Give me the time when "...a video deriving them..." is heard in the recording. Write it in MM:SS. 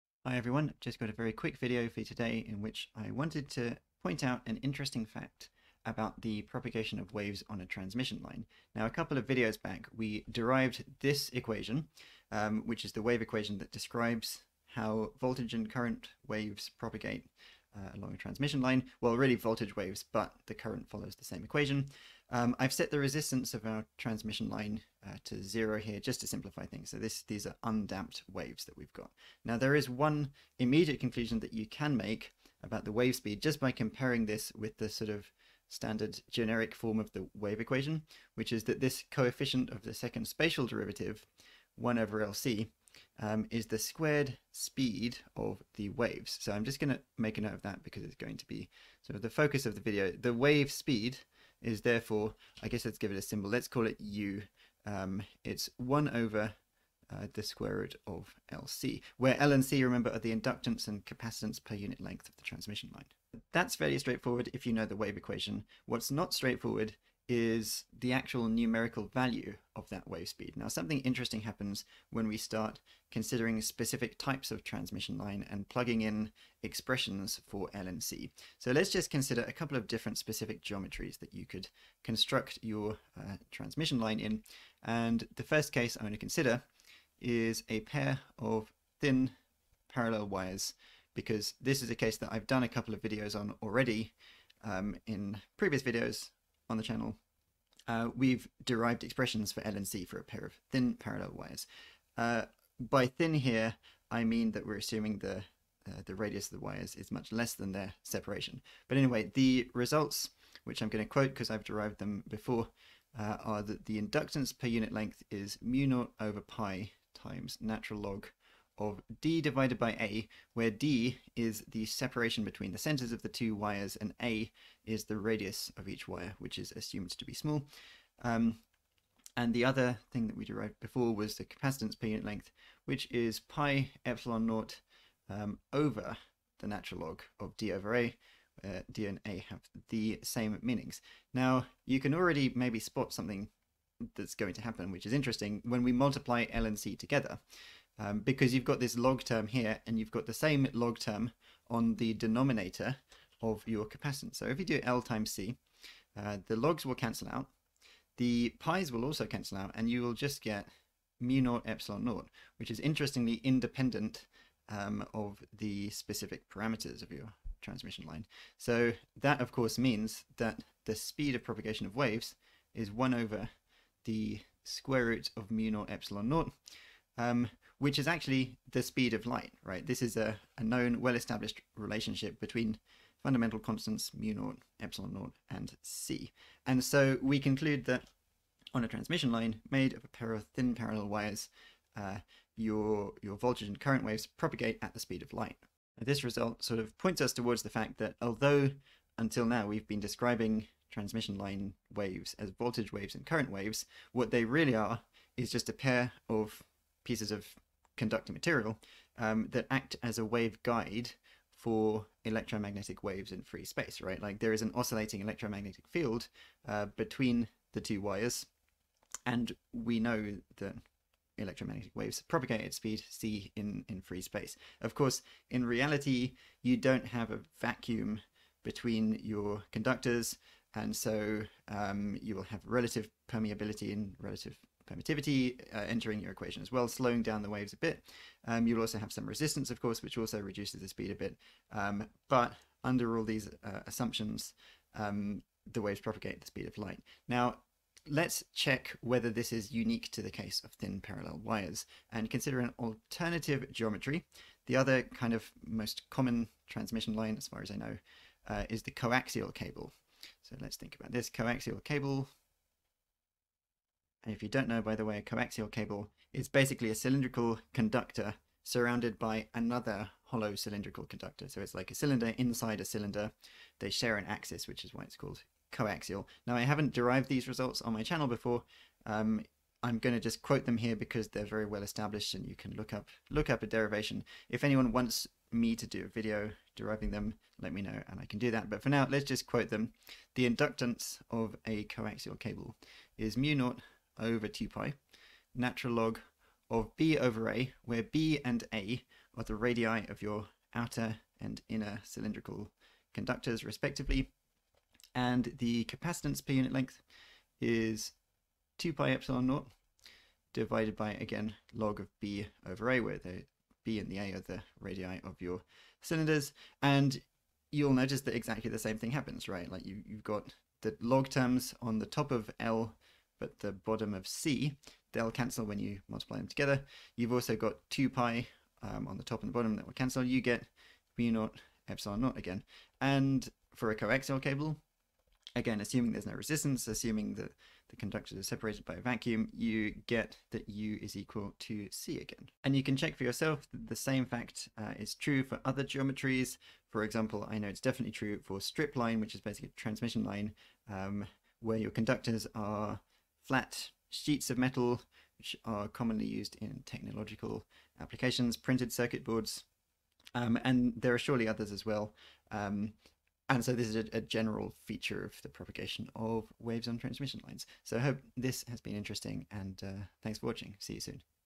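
04:46.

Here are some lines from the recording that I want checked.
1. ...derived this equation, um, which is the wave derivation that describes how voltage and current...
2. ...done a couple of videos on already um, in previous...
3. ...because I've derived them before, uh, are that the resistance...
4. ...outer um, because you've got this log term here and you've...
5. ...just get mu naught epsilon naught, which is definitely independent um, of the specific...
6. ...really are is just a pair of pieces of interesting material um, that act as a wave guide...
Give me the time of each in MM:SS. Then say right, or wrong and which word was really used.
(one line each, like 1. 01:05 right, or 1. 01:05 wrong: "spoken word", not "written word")
1. 00:10 wrong: "equation", not "derivation"
2. 01:32 right
3. 01:51 wrong: "inductance", not "resistance"
4. 02:26 wrong: "together", not "outer"
5. 02:40 wrong: "interestingly", not "definitely"
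6. 03:24 wrong: "conducting", not "interesting".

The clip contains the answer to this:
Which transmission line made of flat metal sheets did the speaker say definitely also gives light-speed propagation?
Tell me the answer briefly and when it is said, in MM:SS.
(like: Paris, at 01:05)
strip line, at 05:48.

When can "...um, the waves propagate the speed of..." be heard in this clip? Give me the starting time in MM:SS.
04:04.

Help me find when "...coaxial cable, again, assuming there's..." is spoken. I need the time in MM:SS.
05:33.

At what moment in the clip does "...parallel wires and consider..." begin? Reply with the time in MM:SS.
04:11.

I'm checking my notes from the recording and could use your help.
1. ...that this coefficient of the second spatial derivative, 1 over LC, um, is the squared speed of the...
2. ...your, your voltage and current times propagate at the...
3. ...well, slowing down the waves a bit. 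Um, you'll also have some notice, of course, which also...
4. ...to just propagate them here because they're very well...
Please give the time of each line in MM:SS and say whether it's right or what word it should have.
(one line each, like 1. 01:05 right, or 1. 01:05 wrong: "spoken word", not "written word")
1. 00:38 right
2. 03:12 wrong: "waves", not "times"
3. 03:56 wrong: "resistance", not "notice"
4. 04:40 wrong: "quote", not "propagate".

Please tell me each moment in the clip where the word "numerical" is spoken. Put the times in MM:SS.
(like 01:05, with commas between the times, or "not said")
01:08.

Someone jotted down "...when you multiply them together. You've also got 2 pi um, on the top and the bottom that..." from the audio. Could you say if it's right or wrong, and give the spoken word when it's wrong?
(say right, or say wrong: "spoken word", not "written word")
right.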